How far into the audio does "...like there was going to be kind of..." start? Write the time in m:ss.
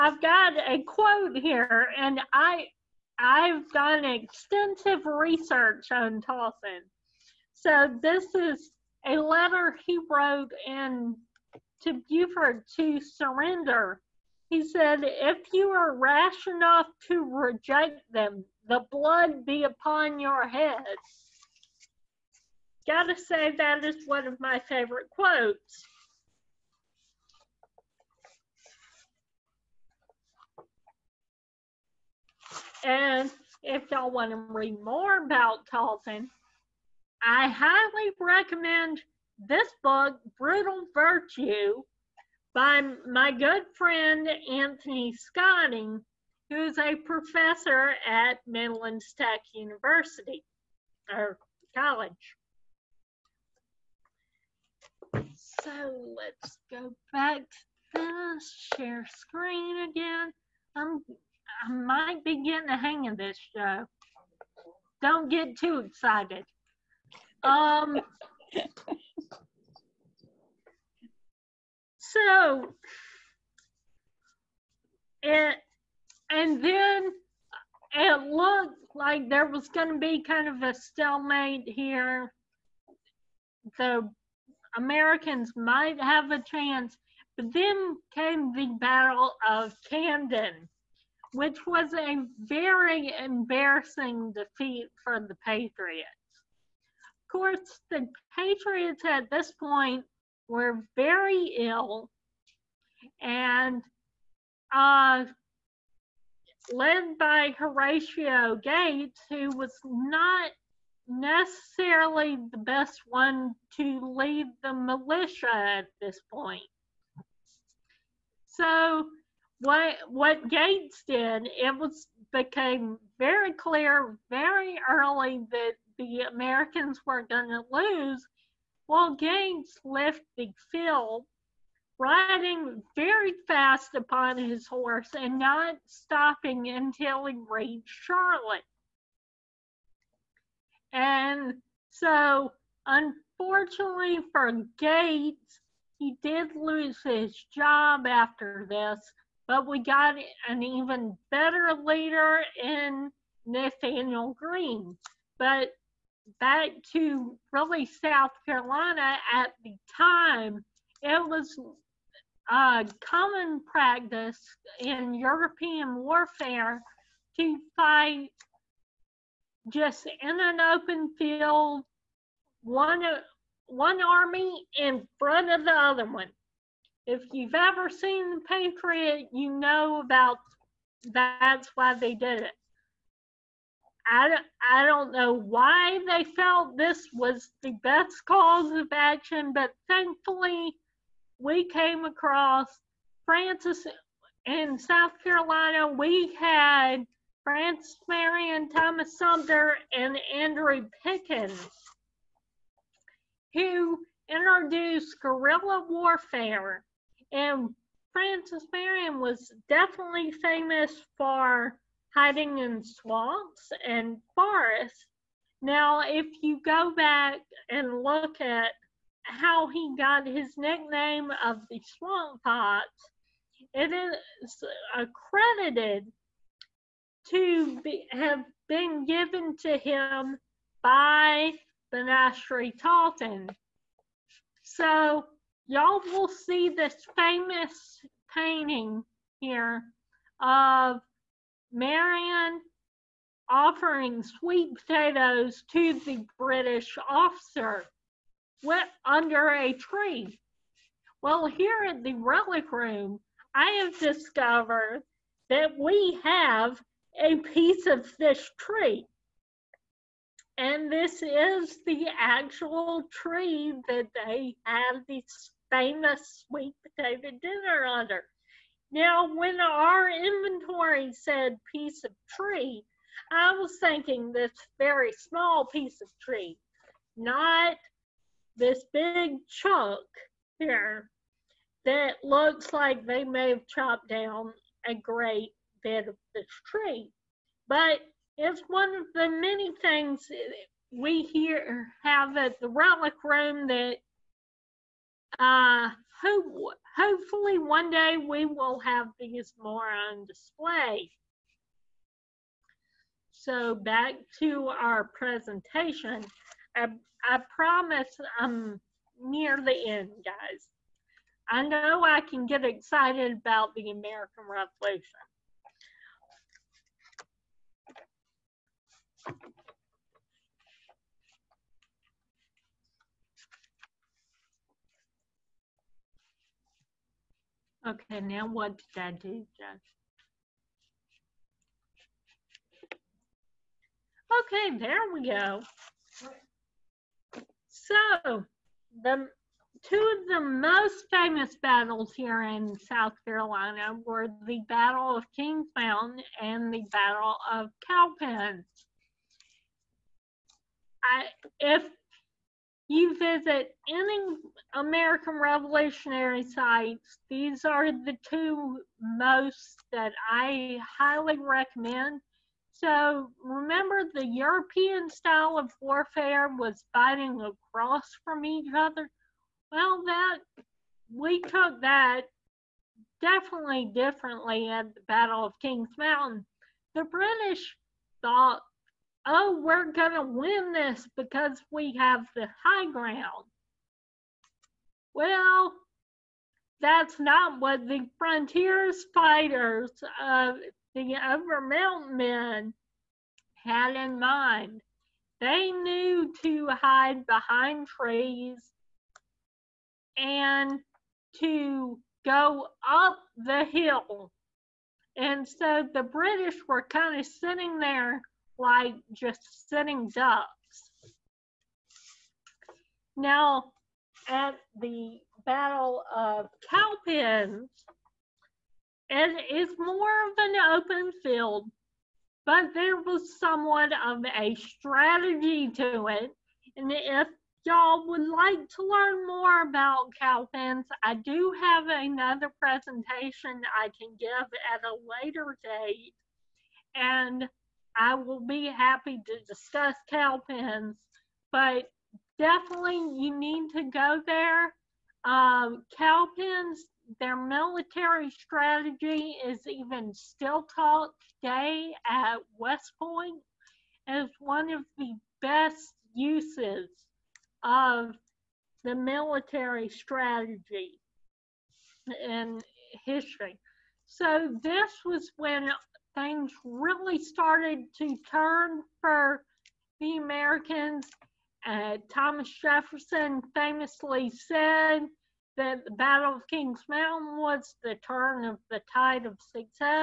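1:18.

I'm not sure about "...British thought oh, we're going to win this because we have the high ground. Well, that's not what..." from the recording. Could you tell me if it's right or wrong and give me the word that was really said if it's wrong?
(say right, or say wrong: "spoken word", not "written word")
right.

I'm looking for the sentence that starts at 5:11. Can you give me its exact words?
I know I can get excited about the American Revolution.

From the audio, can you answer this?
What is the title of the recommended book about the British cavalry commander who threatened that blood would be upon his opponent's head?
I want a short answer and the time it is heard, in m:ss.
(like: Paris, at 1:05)
Brutal Virtue, at 0:40.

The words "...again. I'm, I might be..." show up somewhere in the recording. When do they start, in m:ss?
0:59.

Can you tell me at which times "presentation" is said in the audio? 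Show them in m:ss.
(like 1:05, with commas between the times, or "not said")
5:05, 7:12.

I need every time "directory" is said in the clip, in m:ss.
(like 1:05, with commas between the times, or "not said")
not said.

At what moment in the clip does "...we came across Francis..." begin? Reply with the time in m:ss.
3:11.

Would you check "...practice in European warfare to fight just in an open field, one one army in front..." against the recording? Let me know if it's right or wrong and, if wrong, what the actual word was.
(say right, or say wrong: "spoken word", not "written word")
right.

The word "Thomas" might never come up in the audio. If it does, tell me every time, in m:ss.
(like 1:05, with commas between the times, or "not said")
3:18, 7:52.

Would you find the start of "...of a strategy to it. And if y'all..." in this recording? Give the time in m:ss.
7:04.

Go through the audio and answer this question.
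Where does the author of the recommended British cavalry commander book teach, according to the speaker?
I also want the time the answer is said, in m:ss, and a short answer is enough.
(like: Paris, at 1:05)
Midland Tech, at 0:48.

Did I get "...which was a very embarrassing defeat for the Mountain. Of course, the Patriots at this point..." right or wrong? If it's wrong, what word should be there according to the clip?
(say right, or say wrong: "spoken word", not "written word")
wrong: "Patriots", not "Mountain".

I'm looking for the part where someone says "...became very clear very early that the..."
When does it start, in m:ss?
2:02.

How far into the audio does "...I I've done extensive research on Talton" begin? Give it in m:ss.
0:02.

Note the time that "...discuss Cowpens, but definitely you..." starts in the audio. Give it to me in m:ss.
7:19.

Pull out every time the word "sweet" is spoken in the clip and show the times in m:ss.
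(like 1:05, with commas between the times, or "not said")
4:04, 4:26.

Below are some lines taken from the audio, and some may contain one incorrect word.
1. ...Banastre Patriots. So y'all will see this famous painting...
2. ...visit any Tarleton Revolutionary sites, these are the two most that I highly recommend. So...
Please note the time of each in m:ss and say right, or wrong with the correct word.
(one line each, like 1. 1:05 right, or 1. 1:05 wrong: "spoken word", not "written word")
1. 3:51 wrong: "Tarleton", not "Patriots"
2. 5:53 wrong: "American", not "Tarleton".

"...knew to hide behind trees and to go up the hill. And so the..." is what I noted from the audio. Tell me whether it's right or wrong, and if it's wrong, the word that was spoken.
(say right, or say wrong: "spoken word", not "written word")
right.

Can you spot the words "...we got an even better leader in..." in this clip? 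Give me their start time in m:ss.
2:29.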